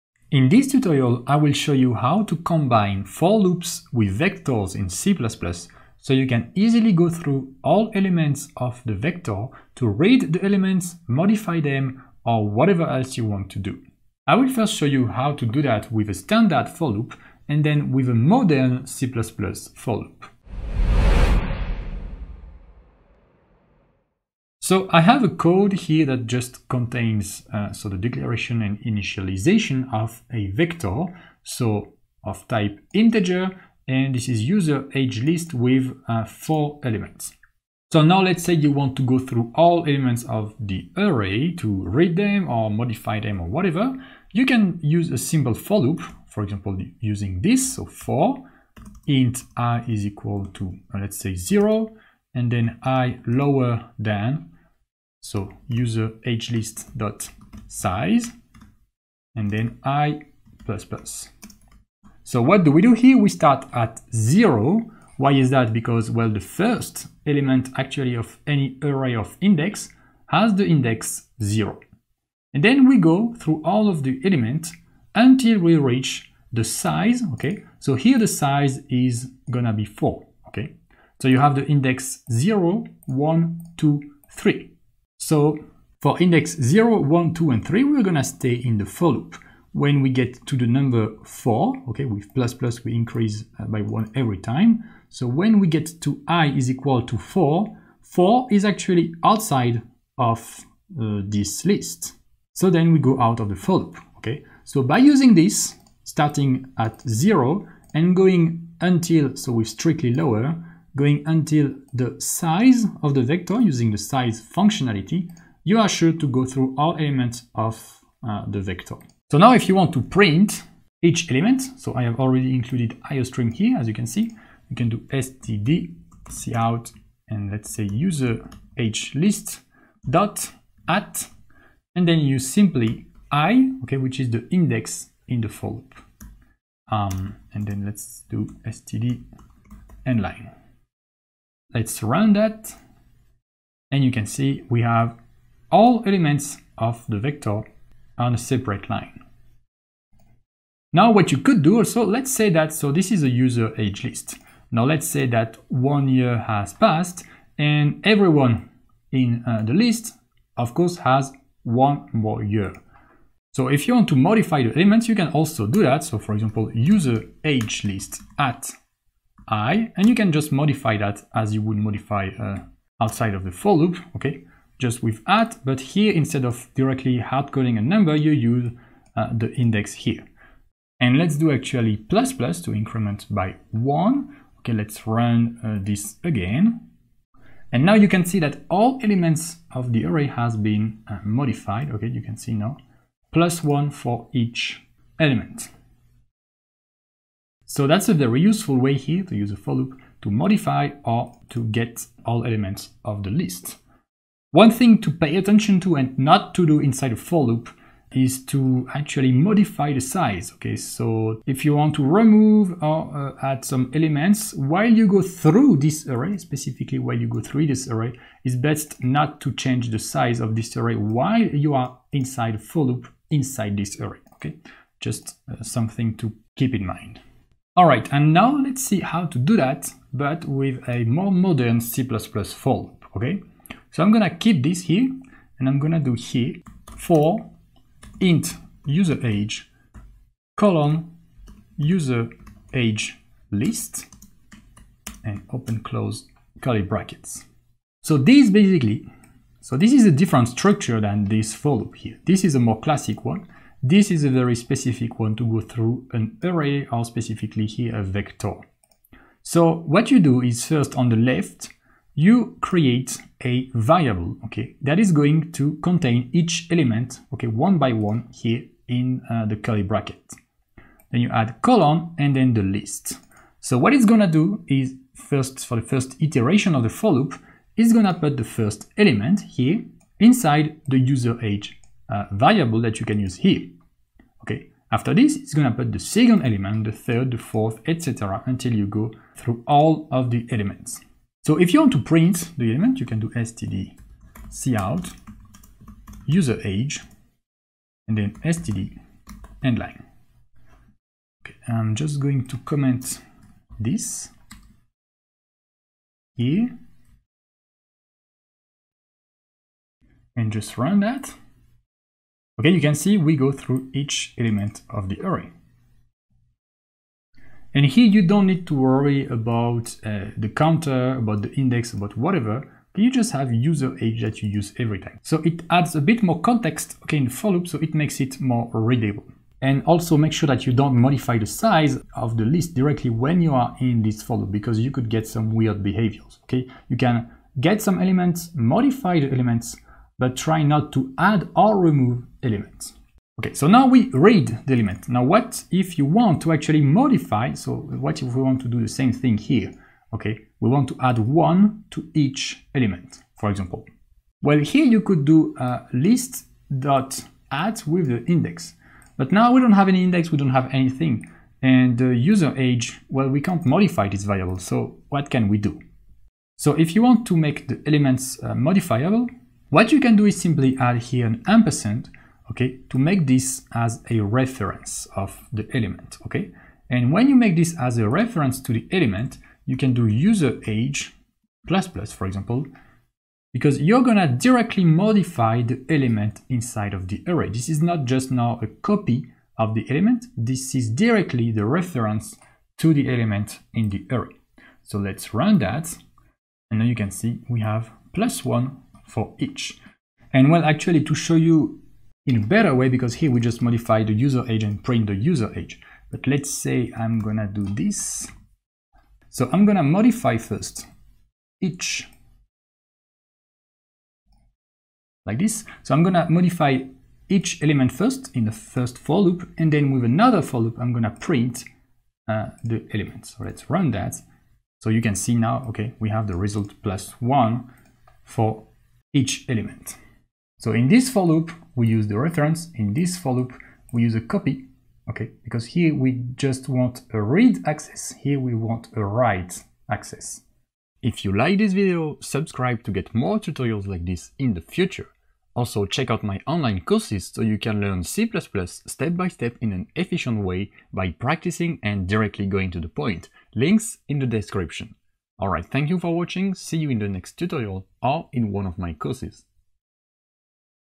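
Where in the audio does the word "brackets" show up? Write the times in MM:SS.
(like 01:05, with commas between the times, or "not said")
04:06, 04:29.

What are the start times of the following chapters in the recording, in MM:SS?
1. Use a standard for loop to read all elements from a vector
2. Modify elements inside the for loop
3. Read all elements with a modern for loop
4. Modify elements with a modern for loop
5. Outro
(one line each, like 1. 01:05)
1. 00:24
2. 02:30
3. 03:47
4. 05:43
5. 07:20.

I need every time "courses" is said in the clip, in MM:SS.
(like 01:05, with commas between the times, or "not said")
02:40, 07:26, 07:38.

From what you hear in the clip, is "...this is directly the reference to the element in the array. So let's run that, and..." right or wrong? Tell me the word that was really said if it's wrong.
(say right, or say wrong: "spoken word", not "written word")
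right.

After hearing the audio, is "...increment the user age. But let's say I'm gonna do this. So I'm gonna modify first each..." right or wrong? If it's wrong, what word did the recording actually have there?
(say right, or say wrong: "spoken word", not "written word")
wrong: "print", not "increment".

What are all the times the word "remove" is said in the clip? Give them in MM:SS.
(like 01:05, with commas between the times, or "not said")
03:32, 05:41.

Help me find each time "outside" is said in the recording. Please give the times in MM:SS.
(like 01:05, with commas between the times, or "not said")
01:39, 02:53.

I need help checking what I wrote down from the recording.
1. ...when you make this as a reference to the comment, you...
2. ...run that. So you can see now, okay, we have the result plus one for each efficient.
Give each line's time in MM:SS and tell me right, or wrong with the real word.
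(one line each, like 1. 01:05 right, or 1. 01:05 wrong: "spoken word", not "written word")
1. 06:17 wrong: "element", not "comment"
2. 07:03 wrong: "element", not "efficient".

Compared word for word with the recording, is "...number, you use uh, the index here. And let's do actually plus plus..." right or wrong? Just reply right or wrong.
right.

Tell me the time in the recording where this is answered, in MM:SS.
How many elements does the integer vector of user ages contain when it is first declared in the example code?
00:36.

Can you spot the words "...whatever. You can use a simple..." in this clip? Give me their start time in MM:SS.
00:43.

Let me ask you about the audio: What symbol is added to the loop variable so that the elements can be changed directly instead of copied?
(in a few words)
ampersand.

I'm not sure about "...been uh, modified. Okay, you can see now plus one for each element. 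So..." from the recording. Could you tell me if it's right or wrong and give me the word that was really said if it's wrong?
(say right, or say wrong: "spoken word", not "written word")
right.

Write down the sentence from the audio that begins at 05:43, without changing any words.
Okay, so now we read the element.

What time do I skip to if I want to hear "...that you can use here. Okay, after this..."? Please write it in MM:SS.
04:42.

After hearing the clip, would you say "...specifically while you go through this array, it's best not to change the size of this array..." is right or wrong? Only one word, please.
right.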